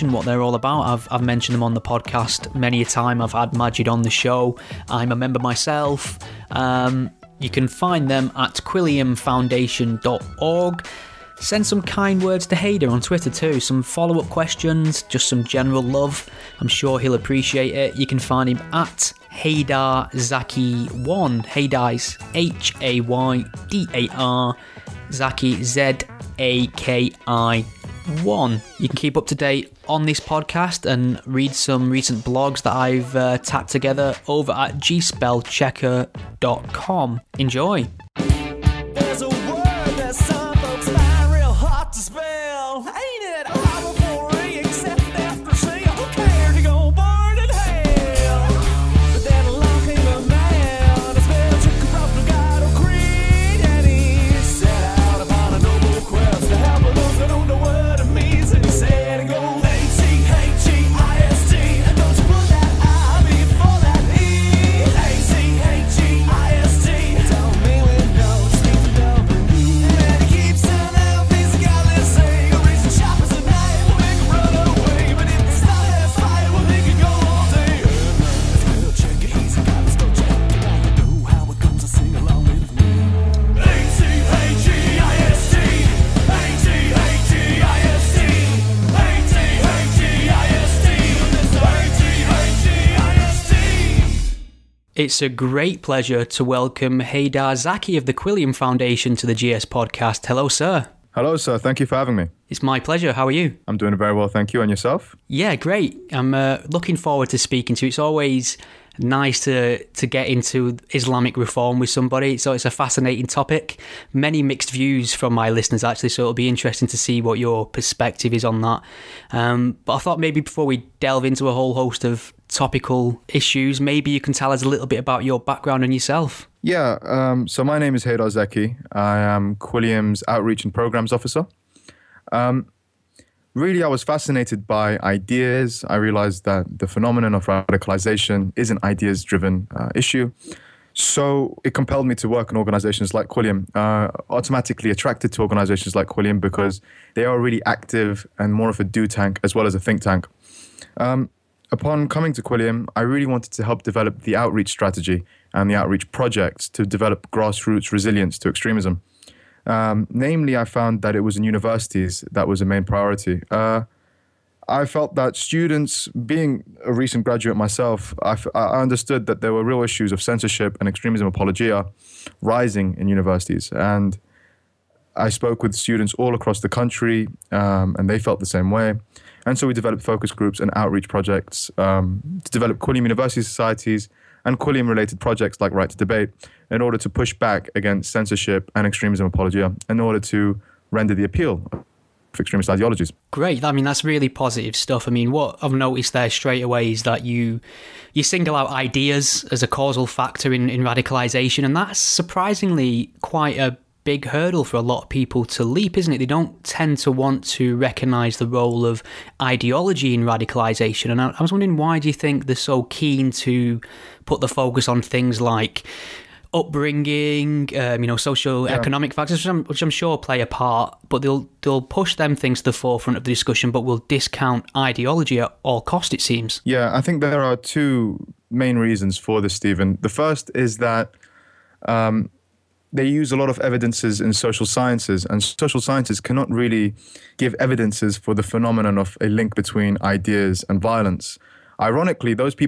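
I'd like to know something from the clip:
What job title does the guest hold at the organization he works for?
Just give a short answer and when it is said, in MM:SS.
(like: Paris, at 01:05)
Outreach and Programs Officer, at 02:10.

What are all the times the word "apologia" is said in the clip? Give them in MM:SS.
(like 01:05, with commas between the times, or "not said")
02:51, 03:09.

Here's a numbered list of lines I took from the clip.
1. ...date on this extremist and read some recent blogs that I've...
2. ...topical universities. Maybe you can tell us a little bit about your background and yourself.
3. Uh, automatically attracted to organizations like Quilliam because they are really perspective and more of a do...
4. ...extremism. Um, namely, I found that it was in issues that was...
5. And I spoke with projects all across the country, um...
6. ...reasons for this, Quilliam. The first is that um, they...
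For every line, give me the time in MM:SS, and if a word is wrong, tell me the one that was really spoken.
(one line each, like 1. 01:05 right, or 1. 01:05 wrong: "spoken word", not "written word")
1. 00:29 wrong: "podcast", not "extremist"
2. 02:02 wrong: "issues", not "universities"
3. 02:23 wrong: "active", not "perspective"
4. 02:38 wrong: "universities", not "issues"
5. 02:53 wrong: "students", not "projects"
6. 03:48 wrong: "Stephen", not "Quilliam".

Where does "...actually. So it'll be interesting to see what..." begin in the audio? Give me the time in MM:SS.
01:55.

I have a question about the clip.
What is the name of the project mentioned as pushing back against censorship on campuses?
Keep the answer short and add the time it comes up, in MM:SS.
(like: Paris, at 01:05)
Right to Debate, at 03:05.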